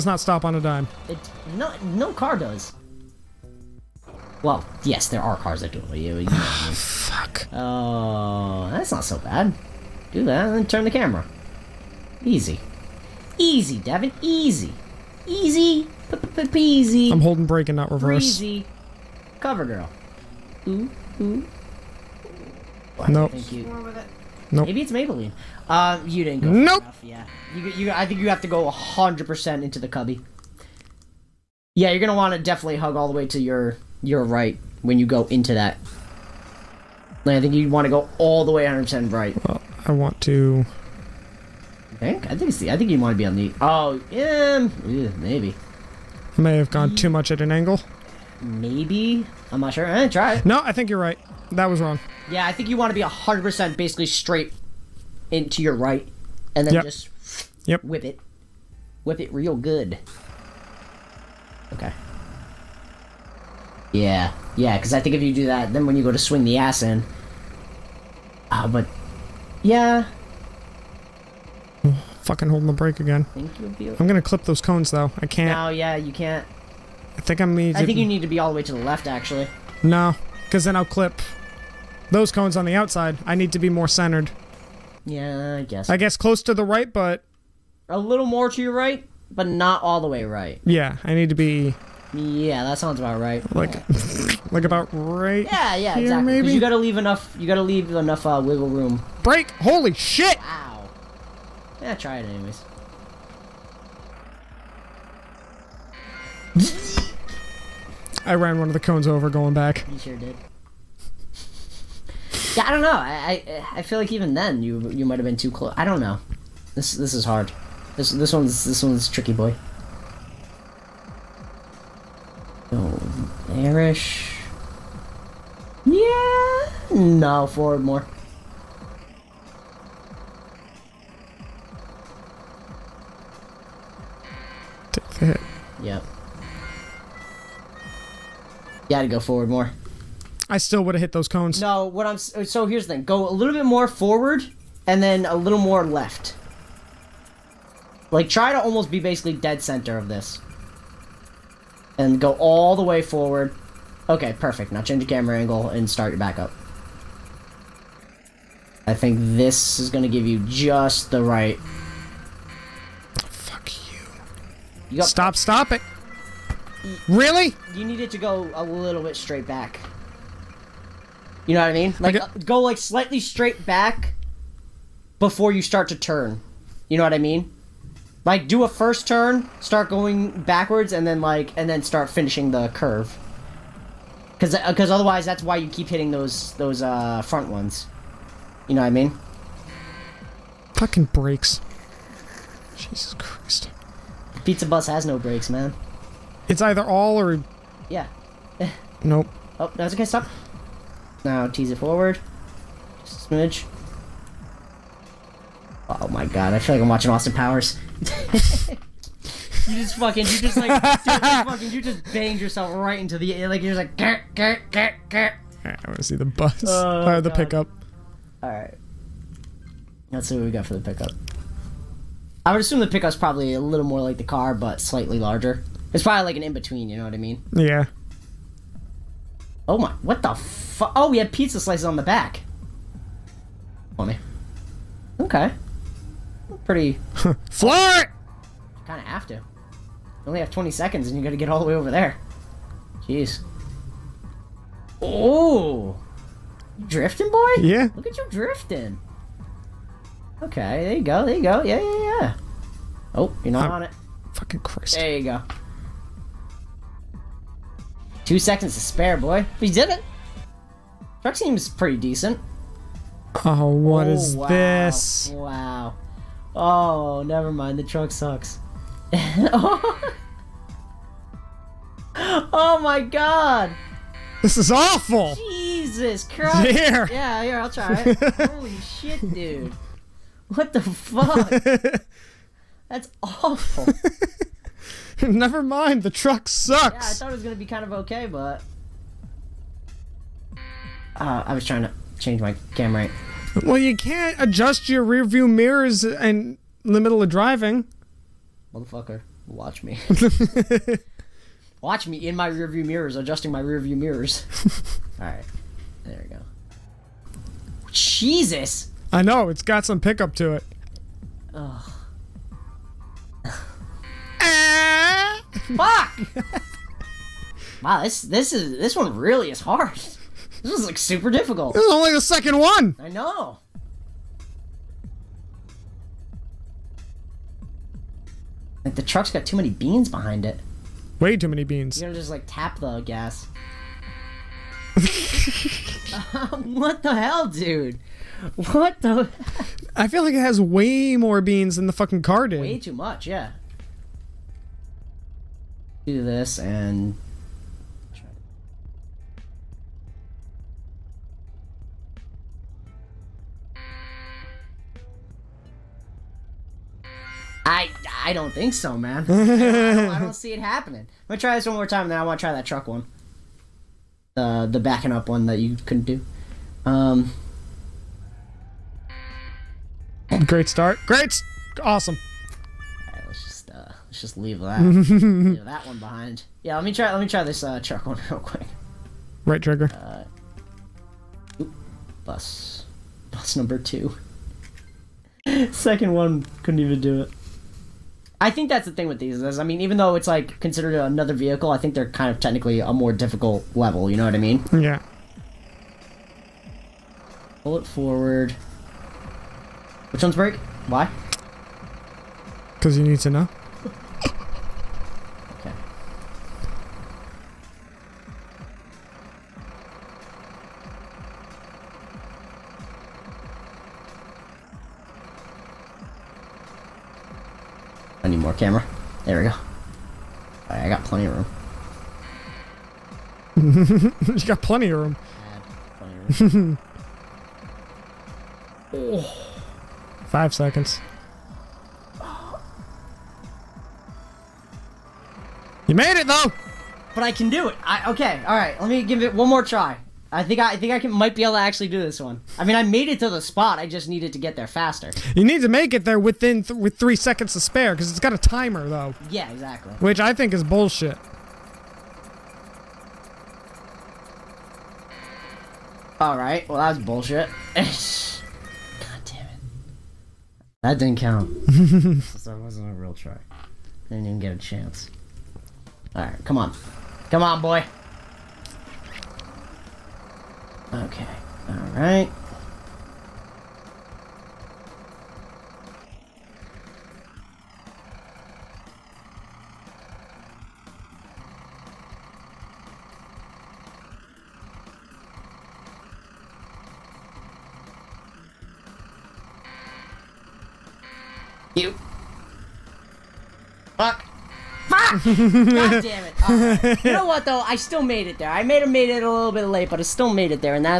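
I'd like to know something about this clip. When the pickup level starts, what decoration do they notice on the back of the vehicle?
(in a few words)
pizza slices.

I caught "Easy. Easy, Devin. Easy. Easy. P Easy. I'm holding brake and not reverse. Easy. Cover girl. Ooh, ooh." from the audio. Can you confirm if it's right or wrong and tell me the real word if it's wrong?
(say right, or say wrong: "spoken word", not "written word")
right.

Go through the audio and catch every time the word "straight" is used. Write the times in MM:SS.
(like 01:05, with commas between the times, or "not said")
00:54, 02:49, 02:53.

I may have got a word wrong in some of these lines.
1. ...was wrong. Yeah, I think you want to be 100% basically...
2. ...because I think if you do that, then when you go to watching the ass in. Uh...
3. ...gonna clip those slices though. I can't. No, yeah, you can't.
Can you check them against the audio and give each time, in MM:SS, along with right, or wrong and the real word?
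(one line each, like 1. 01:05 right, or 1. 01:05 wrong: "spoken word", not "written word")
1. 00:51 right
2. 01:04 wrong: "swing", not "watching"
3. 01:14 wrong: "cones", not "slices".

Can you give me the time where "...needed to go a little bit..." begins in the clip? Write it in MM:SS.
02:47.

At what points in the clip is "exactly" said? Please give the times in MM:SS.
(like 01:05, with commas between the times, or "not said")
01:36, 07:29.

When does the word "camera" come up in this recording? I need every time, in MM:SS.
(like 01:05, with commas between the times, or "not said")
00:10, 02:35, 04:52, 06:58.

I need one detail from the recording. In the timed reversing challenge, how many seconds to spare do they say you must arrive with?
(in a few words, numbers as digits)
3.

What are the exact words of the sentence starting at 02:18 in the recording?
You had to go forward more.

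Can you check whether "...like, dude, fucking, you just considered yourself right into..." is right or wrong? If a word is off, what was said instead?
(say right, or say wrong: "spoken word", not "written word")
wrong: "banged", not "considered".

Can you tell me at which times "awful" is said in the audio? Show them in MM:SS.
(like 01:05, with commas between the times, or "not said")
04:34, 04:43.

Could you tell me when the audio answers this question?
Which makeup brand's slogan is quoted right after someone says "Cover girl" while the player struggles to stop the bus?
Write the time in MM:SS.
00:24.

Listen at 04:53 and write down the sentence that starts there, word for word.
Well, you can't adjust your rearview mirrors in the middle of driving.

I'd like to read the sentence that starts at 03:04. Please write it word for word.
Because because uh, otherwise, that's why you keep hitting those those uh, front ones.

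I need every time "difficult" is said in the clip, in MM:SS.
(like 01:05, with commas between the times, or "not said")
05:21, 06:33.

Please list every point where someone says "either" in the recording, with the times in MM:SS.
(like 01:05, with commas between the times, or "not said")
03:16.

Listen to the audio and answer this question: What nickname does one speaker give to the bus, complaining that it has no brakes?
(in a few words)
Pizza Bus.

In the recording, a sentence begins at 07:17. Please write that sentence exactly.
I, okay, alright, let me give it one more try.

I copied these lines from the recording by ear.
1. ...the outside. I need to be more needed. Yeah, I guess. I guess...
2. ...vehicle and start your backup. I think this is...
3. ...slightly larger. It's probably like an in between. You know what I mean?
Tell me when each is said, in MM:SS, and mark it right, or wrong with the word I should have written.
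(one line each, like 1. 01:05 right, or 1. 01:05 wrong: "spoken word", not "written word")
1. 01:22 wrong: "centered", not "needed"
2. 02:35 wrong: "angle", not "vehicle"
3. 03:44 right.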